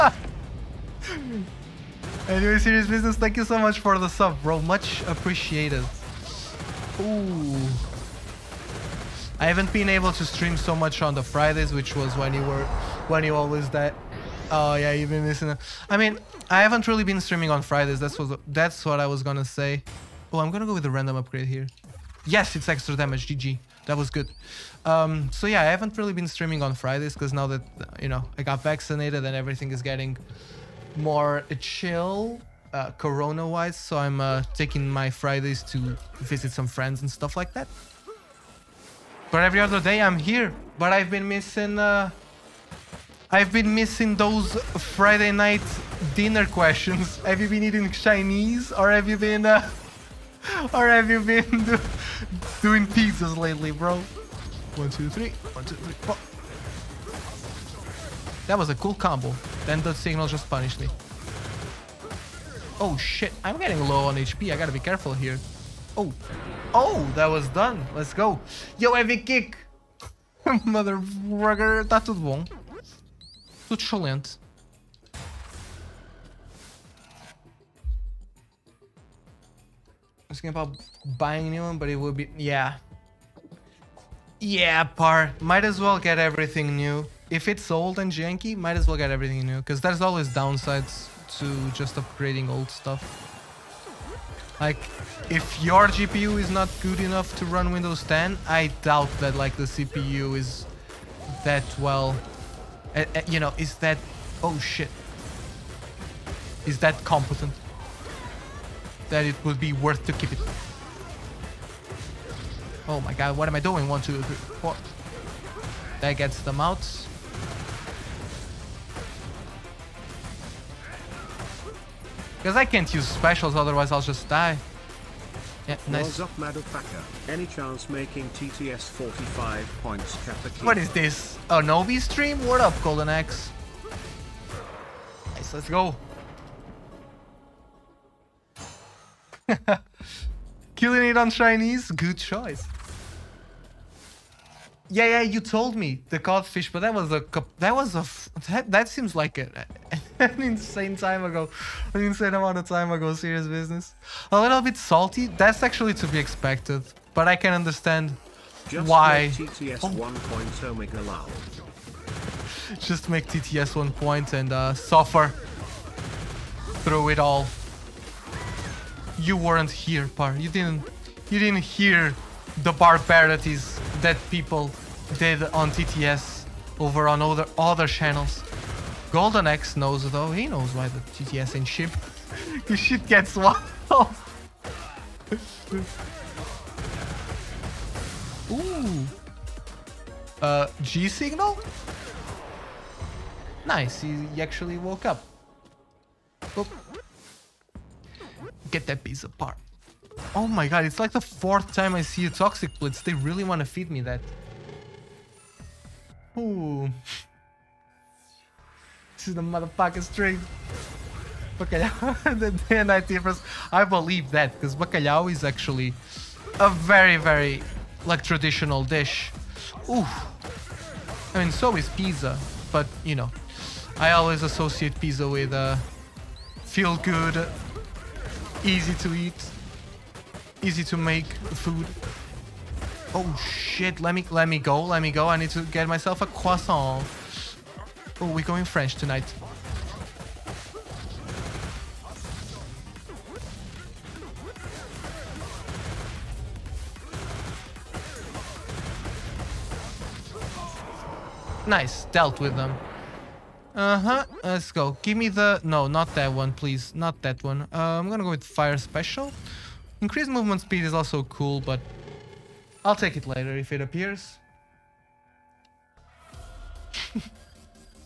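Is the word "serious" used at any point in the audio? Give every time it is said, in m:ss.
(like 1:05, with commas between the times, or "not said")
0:02, 2:33.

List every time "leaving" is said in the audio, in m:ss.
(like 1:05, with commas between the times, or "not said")
not said.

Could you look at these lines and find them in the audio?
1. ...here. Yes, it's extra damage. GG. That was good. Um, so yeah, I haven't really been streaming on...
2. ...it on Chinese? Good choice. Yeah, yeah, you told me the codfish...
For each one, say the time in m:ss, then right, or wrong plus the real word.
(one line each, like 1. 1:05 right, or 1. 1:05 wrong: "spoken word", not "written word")
1. 0:21 right
2. 2:21 right.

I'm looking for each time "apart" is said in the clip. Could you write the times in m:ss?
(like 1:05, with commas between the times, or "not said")
3:19.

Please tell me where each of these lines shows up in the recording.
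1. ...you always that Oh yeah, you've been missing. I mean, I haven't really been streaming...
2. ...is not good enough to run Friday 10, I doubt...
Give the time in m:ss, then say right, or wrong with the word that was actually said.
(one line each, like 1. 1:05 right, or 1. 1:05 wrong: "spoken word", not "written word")
1. 0:13 right
2. 1:36 wrong: "Windows", not "Friday".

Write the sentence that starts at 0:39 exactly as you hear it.
But every other day I'm here.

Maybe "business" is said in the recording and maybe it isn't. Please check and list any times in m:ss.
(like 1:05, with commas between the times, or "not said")
0:02, 2:33.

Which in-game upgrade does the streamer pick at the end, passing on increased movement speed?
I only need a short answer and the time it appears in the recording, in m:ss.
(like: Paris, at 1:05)
Fire Special, at 4:18.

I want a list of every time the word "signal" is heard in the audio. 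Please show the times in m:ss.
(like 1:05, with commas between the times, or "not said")
0:59, 3:11.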